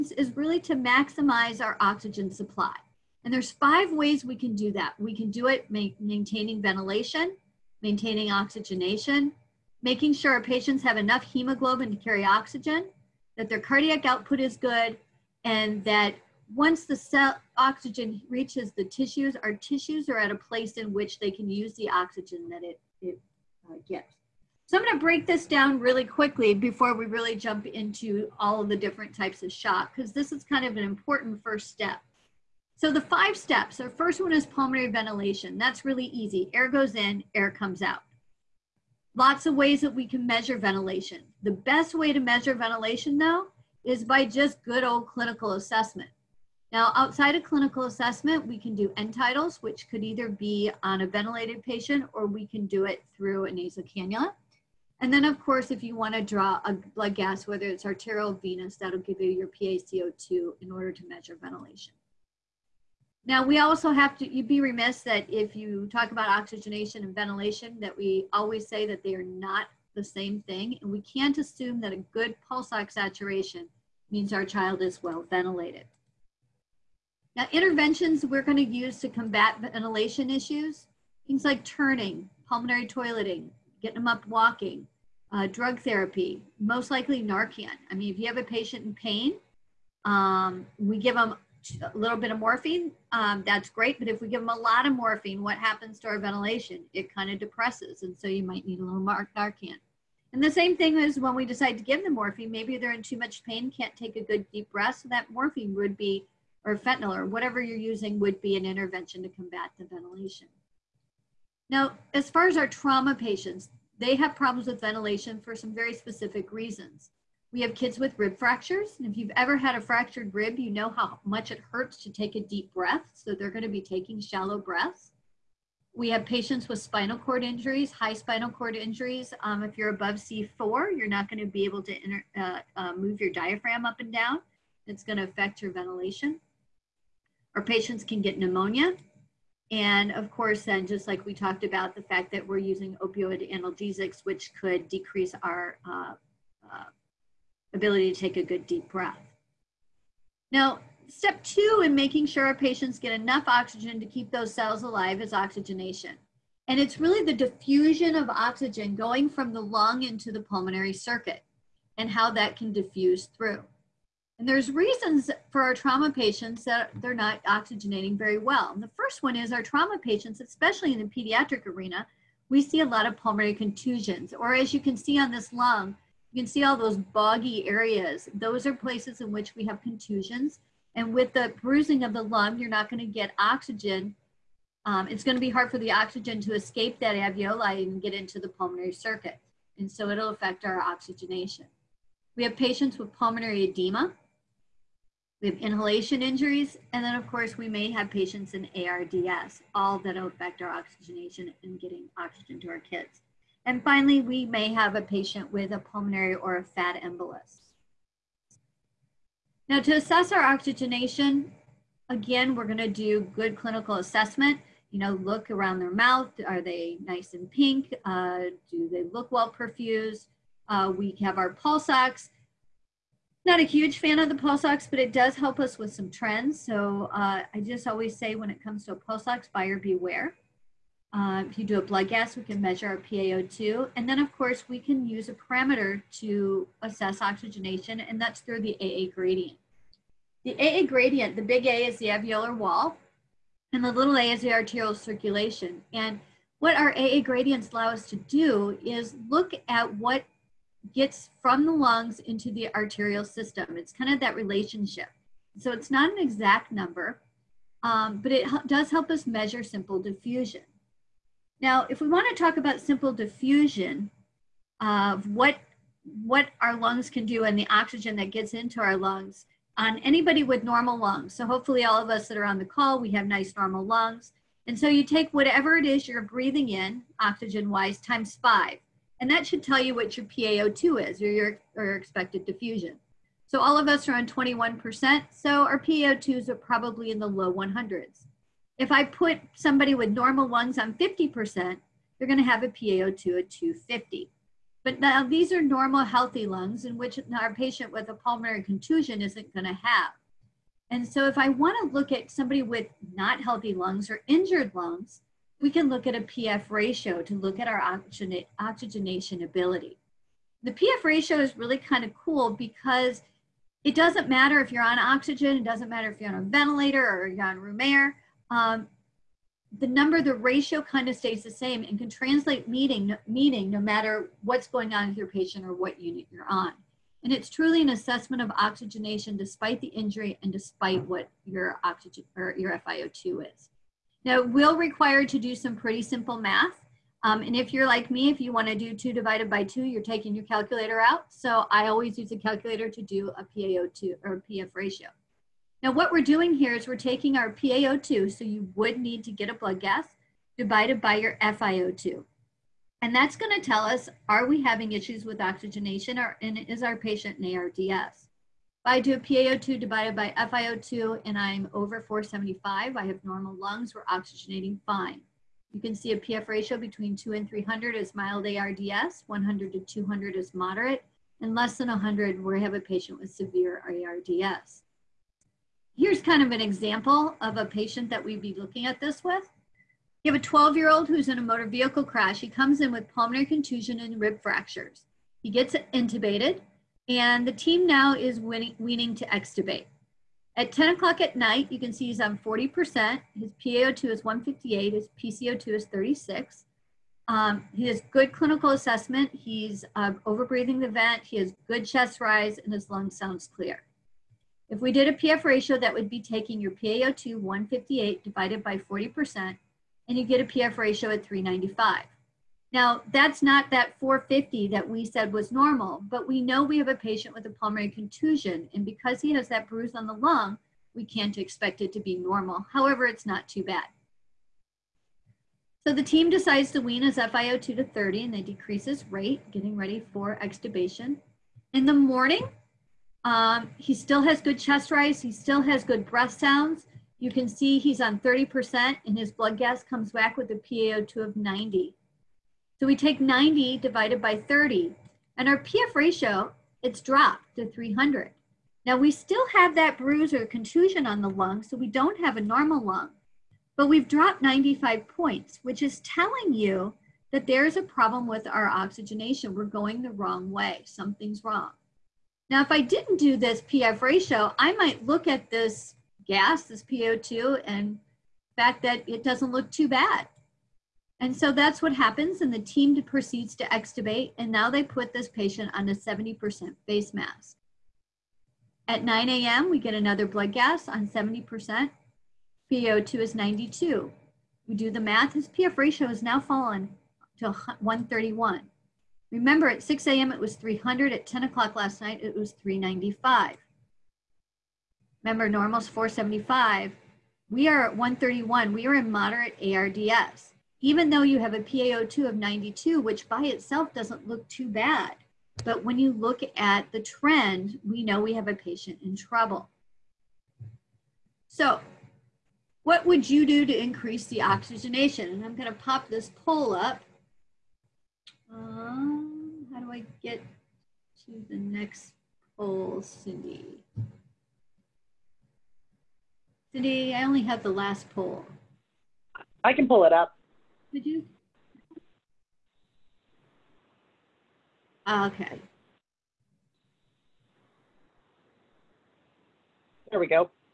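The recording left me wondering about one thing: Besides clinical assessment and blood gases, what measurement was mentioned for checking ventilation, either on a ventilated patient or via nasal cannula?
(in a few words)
end tidals.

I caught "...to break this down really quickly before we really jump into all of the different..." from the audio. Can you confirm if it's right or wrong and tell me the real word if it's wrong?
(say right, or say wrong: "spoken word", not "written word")
right.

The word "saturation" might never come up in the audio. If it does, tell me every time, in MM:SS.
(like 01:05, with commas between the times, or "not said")
01:12.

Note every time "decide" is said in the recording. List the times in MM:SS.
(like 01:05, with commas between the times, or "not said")
01:41, 07:06.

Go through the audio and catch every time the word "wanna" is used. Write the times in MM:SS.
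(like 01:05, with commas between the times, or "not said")
00:55, 05:01.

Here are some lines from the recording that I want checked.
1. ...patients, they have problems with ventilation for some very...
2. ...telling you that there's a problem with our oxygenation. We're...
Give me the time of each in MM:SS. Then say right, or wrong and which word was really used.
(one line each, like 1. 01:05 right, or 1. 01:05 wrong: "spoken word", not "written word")
1. 01:53 right
2. 07:35 right.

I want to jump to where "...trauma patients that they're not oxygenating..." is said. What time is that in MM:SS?
02:45.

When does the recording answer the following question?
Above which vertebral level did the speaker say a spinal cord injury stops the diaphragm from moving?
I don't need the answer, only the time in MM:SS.
02:10.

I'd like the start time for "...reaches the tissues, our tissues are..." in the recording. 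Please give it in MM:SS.
00:18.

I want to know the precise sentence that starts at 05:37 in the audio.
Um, and if you're like me, if you want to do 2 divided by 2, you're taking your calculator out.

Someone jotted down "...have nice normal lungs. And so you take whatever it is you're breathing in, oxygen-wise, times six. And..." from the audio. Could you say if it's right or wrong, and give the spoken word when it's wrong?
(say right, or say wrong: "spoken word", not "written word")
wrong: "five", not "six".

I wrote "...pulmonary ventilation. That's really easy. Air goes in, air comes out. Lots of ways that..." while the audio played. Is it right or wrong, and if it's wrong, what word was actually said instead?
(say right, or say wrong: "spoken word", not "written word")
right.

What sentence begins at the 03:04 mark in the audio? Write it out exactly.
Um, it's going to be hard for the oxygen to escape that alveoli and get into the pulmonary circuit.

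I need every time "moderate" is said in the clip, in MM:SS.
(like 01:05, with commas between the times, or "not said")
06:10, 08:19.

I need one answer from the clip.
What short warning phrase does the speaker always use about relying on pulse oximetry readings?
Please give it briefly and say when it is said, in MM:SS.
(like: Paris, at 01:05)
buyer beware, at 03:49.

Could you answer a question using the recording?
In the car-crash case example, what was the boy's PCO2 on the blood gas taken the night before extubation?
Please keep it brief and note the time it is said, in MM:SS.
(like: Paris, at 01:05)
36, at 06:35.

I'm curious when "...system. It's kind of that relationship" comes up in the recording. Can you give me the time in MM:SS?
04:13.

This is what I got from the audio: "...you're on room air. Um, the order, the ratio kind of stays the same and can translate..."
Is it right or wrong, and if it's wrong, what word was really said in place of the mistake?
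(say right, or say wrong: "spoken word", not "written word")
wrong: "number", not "order".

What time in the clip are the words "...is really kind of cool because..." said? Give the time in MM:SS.
05:11.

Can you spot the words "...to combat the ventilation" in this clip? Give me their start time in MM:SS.
01:49.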